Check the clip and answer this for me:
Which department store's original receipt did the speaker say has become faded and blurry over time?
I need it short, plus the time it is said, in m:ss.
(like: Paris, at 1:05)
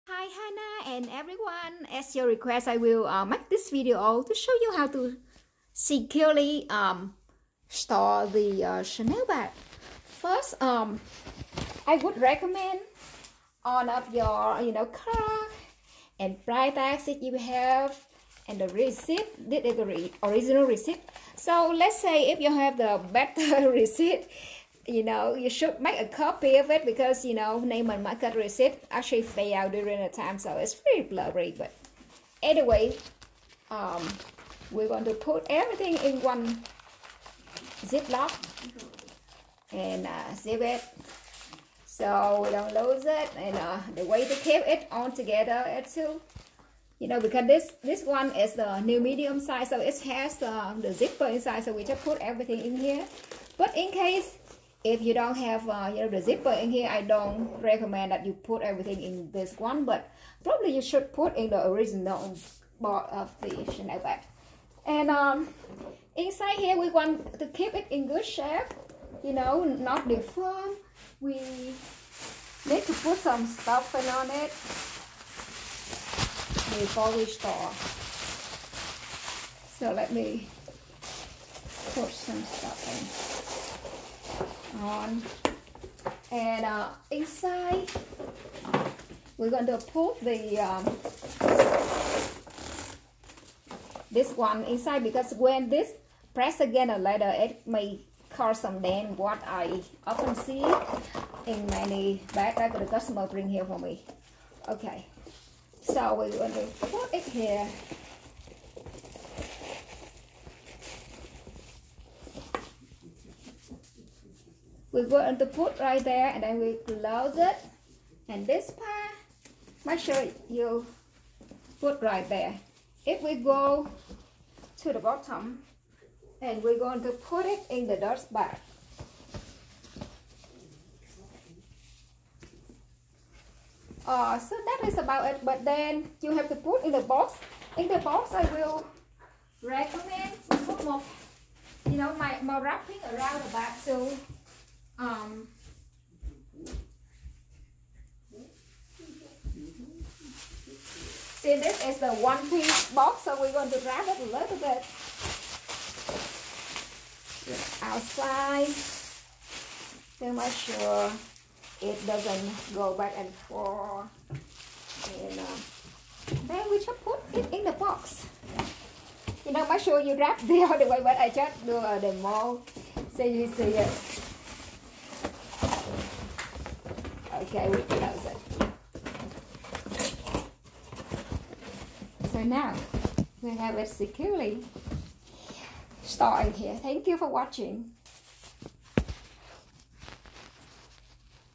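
Neiman Marcus, at 0:27.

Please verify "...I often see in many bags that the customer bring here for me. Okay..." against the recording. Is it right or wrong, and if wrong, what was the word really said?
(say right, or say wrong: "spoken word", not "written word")
right.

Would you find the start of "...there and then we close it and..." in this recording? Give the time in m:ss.
1:56.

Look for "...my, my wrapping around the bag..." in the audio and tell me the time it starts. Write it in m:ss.
2:22.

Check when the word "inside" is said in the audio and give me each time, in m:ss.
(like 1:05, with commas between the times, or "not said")
0:51, 1:06, 1:27, 1:34.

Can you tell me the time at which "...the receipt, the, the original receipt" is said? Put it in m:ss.
0:18.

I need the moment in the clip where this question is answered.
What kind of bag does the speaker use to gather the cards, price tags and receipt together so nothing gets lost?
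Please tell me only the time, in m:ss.
0:37.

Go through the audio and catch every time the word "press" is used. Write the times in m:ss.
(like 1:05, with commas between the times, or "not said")
1:36.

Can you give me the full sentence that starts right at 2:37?
Outside to make sure it doesn't go back and forth.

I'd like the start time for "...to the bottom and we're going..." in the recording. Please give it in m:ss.
2:04.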